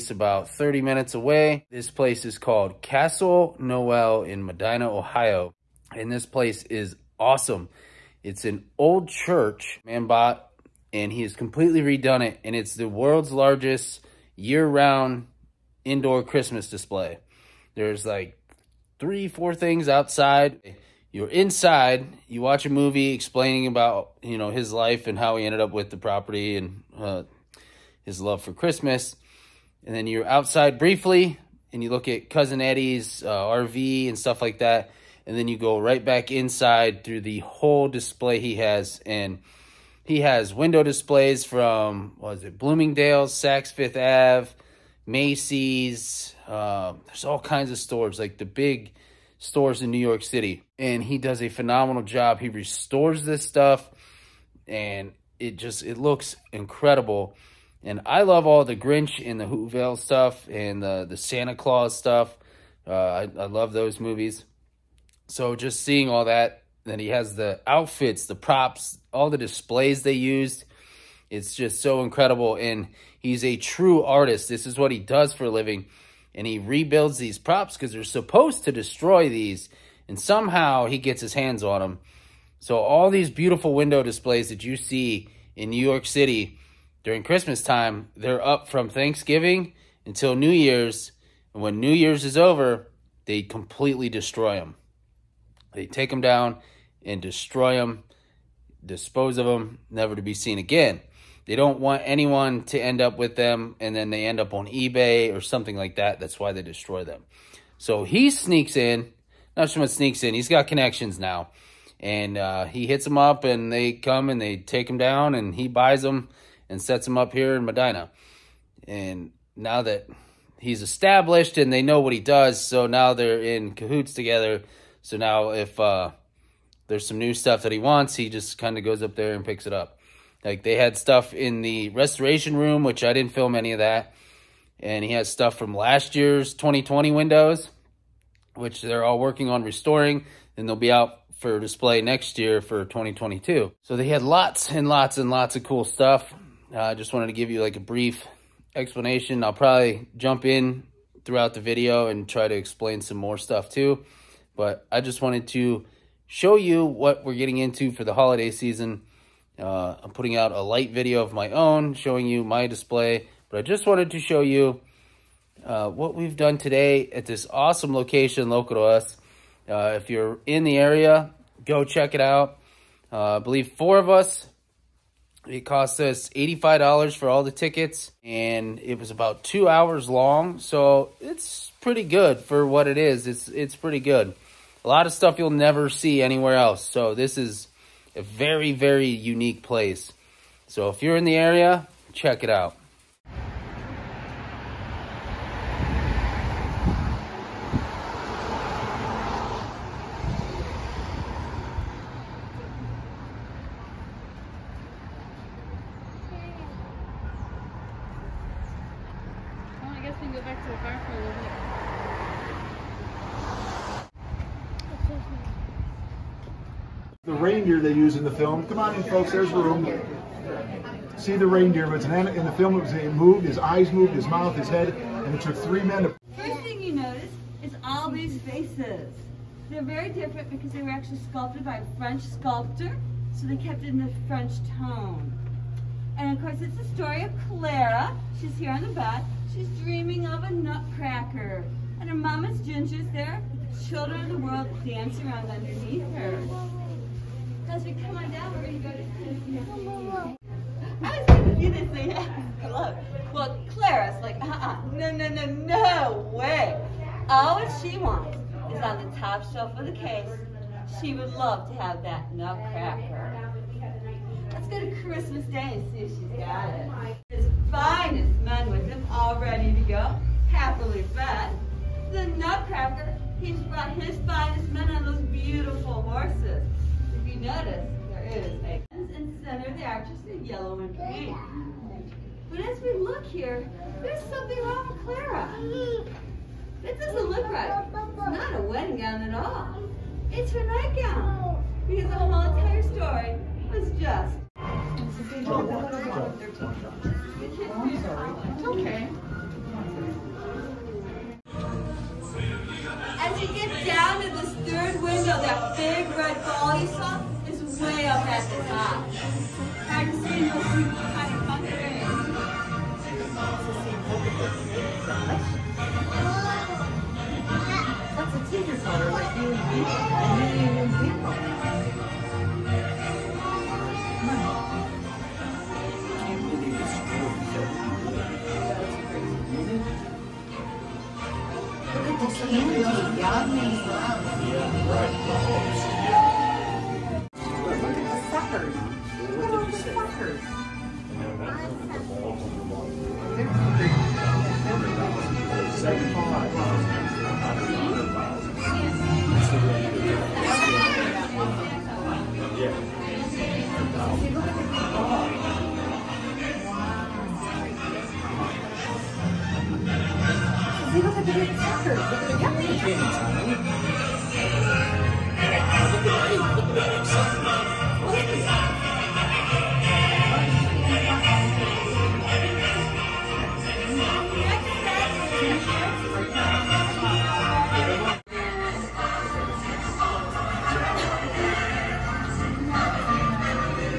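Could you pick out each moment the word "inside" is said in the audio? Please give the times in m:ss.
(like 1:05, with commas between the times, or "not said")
0:21, 0:36.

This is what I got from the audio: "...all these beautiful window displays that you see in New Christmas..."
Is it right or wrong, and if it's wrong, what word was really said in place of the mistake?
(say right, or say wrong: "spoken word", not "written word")
wrong: "York", not "Christmas".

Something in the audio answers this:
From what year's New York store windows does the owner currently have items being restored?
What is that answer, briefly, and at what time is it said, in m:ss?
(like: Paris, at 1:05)
2020, at 2:16.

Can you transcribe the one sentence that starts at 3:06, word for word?
So this is a very, very unique place.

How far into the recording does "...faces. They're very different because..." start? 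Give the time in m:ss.
3:48.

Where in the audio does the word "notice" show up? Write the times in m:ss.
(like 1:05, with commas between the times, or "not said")
3:46, 4:37.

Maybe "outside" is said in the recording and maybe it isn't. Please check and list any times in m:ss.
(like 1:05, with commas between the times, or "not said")
0:19, 0:30.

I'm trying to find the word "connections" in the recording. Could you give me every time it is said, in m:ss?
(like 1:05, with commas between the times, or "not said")
1:50.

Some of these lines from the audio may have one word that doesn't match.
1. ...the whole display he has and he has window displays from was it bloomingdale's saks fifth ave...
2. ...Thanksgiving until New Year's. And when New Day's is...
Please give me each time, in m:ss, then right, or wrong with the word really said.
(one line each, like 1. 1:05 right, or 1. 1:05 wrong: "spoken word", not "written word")
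1. 0:37 right
2. 1:28 wrong: "Year", not "Day".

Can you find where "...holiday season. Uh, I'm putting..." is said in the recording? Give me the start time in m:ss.
2:38.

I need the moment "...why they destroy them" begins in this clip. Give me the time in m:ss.
1:46.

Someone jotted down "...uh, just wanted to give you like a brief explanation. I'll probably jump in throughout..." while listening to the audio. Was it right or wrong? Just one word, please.
right.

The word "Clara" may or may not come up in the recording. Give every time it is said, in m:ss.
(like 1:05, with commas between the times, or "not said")
3:57, 4:13, 4:45.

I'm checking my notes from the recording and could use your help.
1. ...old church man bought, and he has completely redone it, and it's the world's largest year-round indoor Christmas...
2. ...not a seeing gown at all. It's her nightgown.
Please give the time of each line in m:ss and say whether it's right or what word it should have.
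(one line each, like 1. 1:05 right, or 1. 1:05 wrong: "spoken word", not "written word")
1. 0:08 right
2. 4:48 wrong: "wedding", not "seeing".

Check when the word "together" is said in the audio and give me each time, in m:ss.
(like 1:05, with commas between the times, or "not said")
2:04.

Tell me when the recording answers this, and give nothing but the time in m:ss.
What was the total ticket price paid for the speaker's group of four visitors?
2:56.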